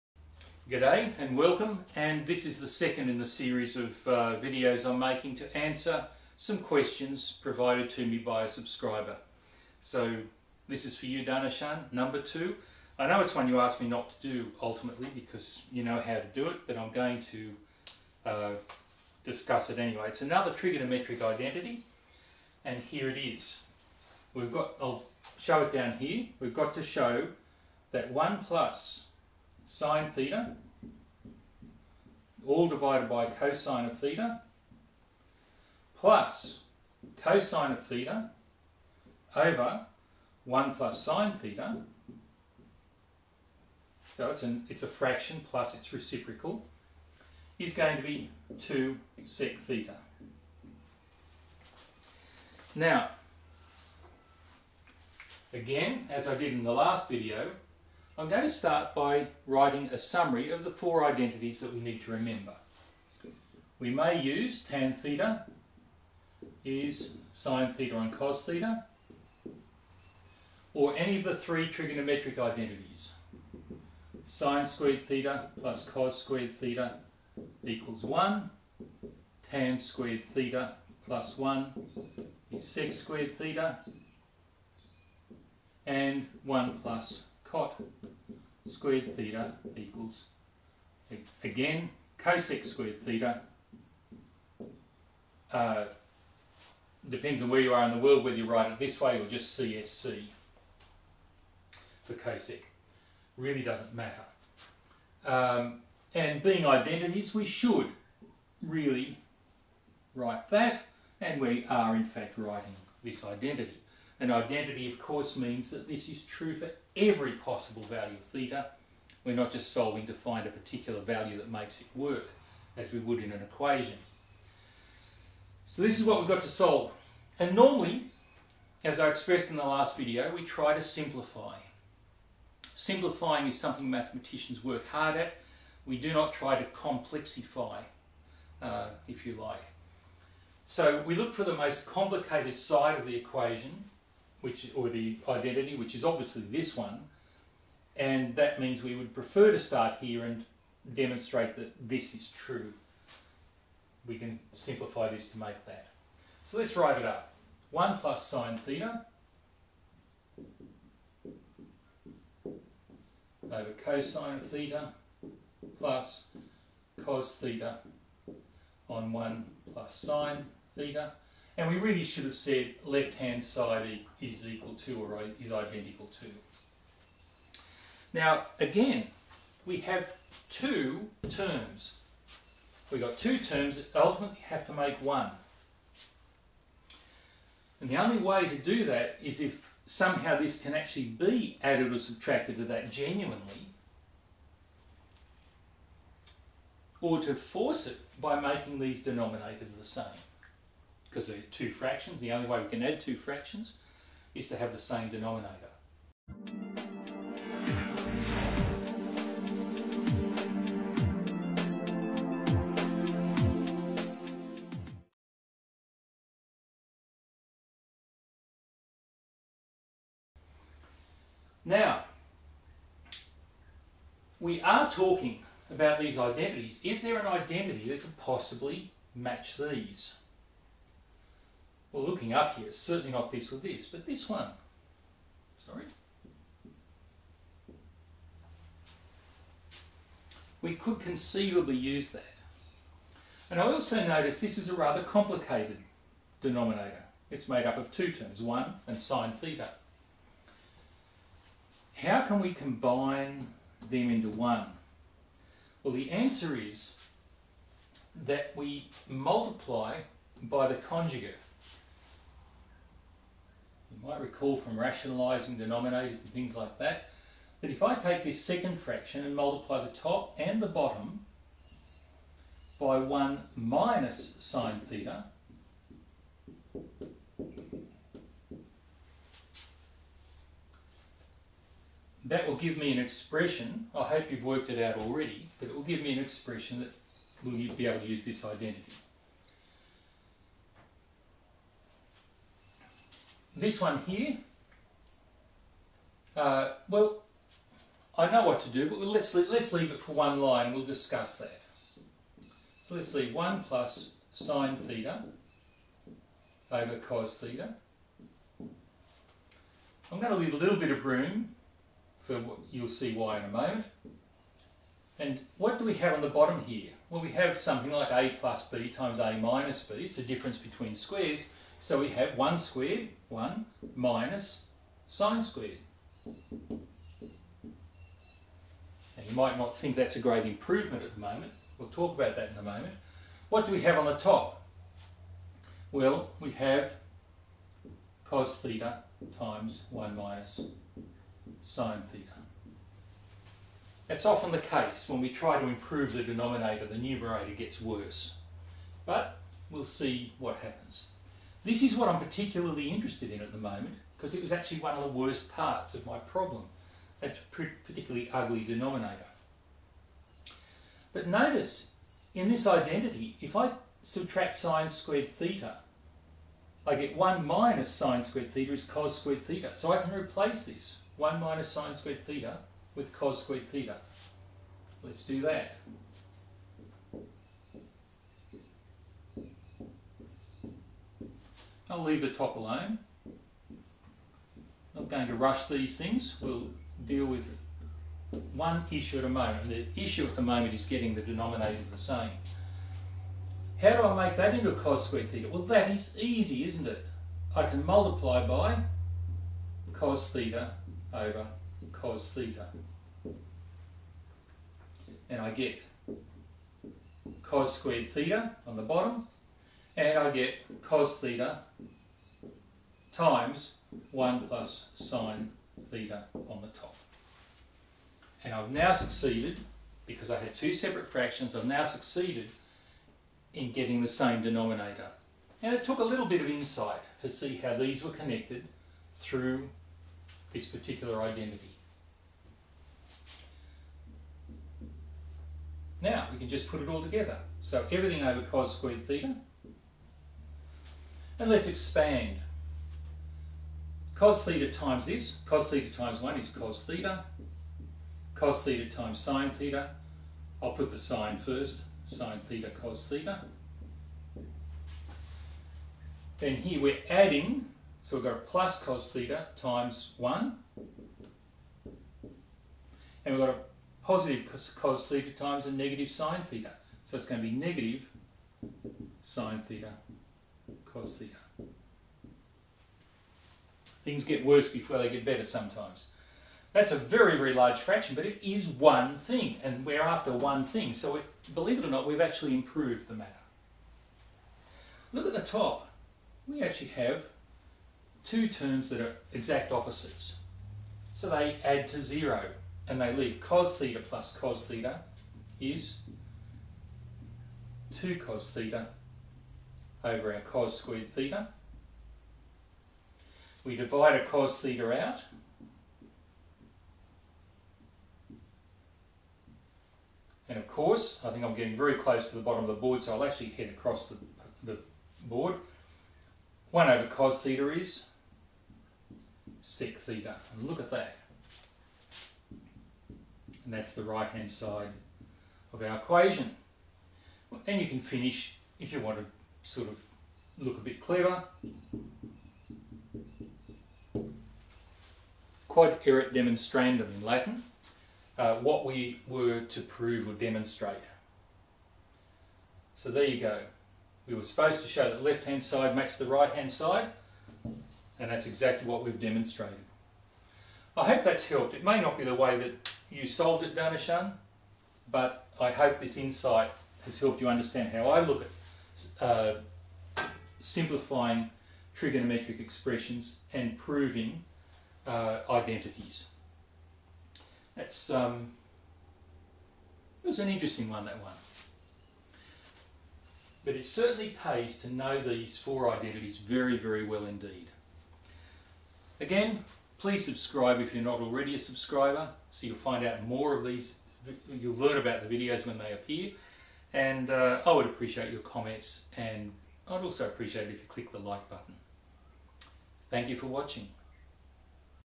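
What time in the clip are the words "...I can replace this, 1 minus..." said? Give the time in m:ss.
6:09.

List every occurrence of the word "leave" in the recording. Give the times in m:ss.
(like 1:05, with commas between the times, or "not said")
4:59, 5:10, 6:22, 8:13.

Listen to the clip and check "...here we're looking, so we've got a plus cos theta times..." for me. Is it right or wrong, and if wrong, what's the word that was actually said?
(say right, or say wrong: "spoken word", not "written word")
wrong: "adding", not "looking".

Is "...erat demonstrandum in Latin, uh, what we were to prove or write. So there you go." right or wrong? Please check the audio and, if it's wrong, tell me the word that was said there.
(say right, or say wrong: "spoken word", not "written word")
wrong: "demonstrate", not "write".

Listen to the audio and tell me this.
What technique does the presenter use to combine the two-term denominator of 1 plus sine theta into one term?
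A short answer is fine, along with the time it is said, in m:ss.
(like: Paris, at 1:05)
multiply by the conjugate, at 4:19.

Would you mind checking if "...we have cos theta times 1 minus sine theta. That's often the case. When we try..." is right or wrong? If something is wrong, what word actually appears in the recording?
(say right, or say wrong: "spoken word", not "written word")
right.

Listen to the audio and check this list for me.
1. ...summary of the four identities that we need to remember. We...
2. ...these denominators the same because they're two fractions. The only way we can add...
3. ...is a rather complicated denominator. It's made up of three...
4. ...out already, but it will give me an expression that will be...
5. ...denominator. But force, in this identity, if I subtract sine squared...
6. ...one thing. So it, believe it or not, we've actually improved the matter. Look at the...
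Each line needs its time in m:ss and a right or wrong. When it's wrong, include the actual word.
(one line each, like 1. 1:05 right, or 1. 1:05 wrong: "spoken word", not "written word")
1. 0:59 right
2. 3:18 right
3. 4:04 wrong: "two", not "three"
4. 4:44 right
5. 5:58 wrong: "notice", not "force"
6. 8:00 right.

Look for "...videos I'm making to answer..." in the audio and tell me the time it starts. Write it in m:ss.
0:04.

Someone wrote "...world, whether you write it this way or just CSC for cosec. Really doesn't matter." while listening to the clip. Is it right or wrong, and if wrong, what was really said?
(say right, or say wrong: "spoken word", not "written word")
right.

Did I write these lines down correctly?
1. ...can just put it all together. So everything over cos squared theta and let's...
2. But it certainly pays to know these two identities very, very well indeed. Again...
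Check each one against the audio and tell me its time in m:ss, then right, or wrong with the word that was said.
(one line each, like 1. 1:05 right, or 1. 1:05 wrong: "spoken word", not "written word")
1. 7:16 right
2. 9:33 wrong: "four", not "two".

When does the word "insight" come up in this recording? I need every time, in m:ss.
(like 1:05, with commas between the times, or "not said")
7:06, 9:16.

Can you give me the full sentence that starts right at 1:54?
And identity, of course, means that this is true for every possible value of theta.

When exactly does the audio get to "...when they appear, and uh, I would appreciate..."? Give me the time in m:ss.
9:45.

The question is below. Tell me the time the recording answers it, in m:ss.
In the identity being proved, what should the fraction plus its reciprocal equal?
0:48.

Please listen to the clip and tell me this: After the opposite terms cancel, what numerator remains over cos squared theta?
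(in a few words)
2 cos theta.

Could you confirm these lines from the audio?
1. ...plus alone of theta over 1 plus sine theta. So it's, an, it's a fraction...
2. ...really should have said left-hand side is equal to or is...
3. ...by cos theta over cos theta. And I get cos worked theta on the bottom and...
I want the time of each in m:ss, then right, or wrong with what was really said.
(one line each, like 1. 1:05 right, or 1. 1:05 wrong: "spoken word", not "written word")
1. 0:35 wrong: "cosine", not "alone"
2. 2:51 right
3. 6:38 wrong: "squared", not "worked".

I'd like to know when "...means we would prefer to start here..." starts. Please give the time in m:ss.
2:28.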